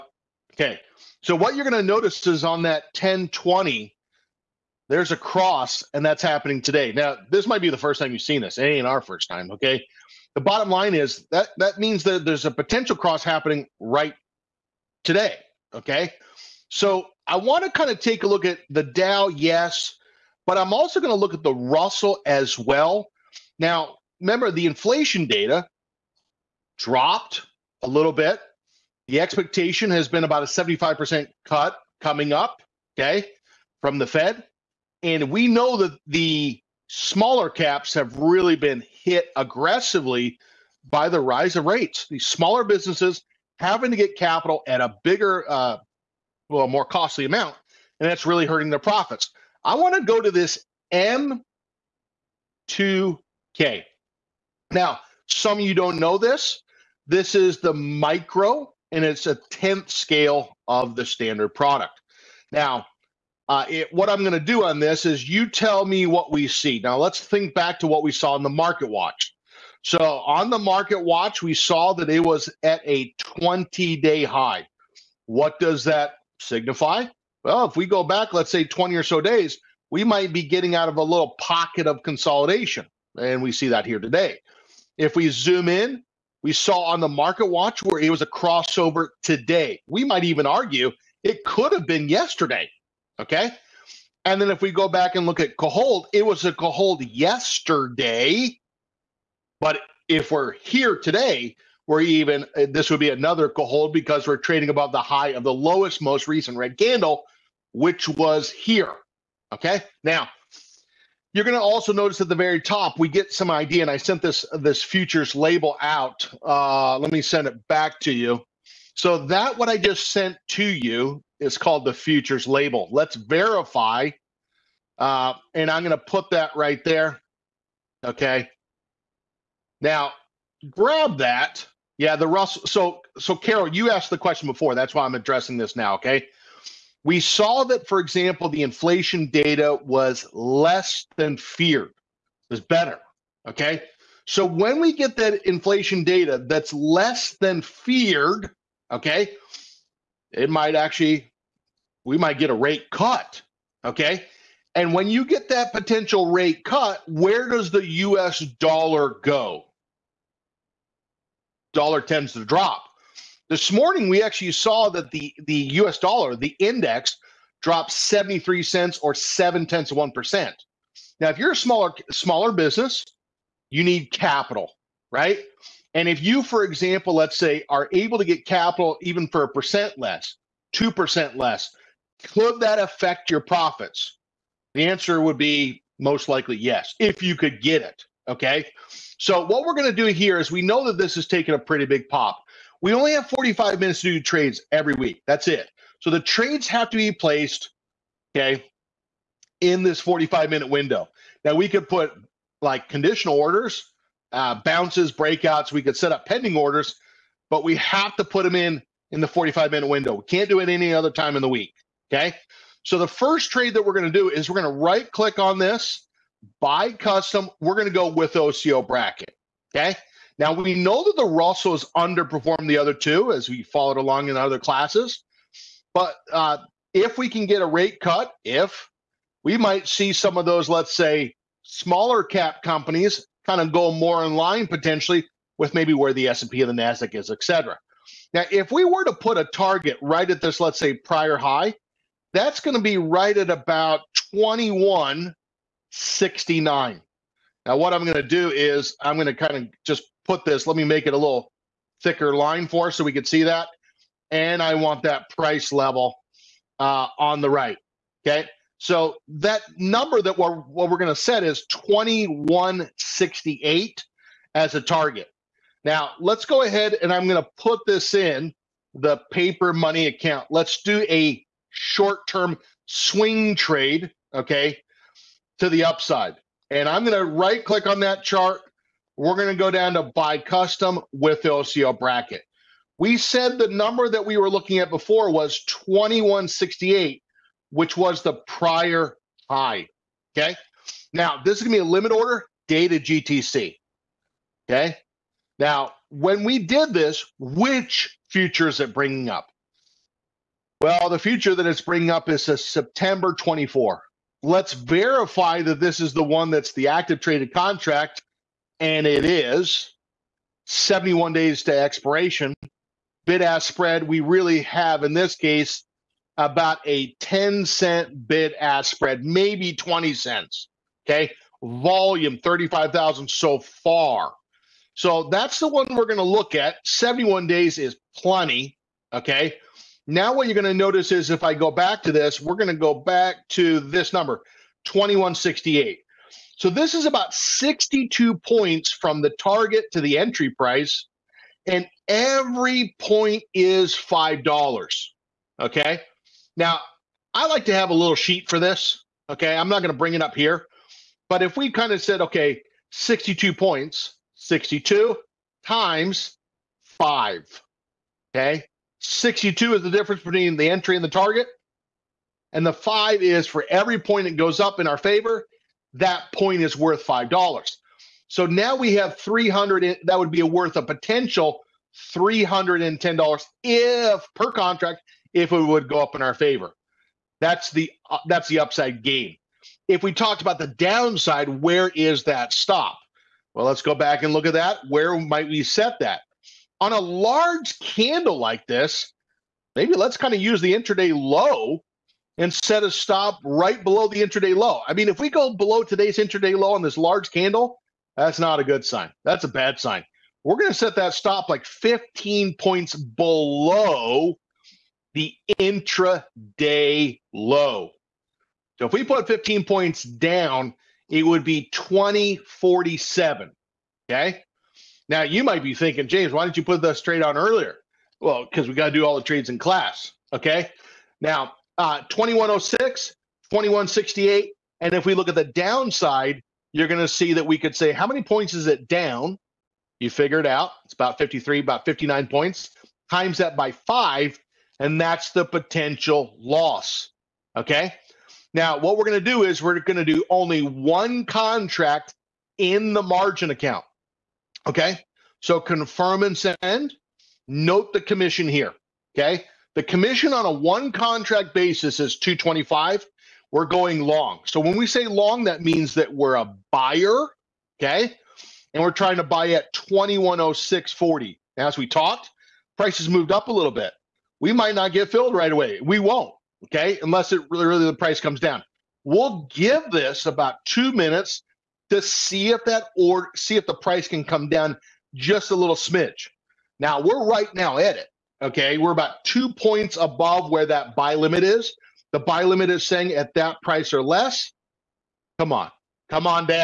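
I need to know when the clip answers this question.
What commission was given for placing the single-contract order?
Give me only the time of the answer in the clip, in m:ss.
7:32.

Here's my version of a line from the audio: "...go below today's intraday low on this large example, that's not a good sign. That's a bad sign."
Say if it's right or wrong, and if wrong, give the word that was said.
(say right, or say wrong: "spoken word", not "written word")
wrong: "candle", not "example".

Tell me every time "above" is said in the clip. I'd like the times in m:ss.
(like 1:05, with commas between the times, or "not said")
1:44, 7:59.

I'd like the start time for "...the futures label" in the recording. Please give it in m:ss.
2:01.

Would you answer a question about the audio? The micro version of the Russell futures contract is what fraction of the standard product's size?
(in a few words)
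a 10th scale.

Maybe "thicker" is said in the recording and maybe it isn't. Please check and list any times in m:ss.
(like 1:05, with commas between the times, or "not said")
4:12.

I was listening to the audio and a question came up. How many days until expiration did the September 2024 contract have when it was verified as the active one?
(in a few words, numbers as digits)
71 days.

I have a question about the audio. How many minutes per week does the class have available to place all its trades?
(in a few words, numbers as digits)
45 minutes.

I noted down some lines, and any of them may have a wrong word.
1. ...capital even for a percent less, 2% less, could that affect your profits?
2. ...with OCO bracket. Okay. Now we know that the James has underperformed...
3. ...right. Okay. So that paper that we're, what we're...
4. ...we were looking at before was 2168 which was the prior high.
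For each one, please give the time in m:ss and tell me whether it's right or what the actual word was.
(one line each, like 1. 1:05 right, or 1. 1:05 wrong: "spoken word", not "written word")
1. 2:58 right
2. 3:38 wrong: "Russell", not "James"
3. 4:17 wrong: "number", not "paper"
4. 4:44 right.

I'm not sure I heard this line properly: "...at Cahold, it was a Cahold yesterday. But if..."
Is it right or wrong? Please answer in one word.
right.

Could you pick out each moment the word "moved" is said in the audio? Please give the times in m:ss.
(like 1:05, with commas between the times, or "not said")
7:43.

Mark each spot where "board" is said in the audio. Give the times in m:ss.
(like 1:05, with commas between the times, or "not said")
not said.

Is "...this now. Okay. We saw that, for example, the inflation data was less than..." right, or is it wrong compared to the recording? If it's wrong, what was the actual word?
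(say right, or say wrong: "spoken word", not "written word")
right.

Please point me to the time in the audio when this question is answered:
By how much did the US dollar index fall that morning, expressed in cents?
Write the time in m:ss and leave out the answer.
2:47.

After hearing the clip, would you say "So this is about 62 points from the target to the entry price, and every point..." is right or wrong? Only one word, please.
right.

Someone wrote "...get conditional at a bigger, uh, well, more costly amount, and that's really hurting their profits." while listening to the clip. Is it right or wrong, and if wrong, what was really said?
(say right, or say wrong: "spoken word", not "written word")
wrong: "capital", not "conditional".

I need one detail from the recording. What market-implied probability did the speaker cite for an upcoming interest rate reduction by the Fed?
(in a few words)
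75%.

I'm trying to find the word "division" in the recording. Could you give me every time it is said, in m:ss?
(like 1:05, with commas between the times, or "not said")
not said.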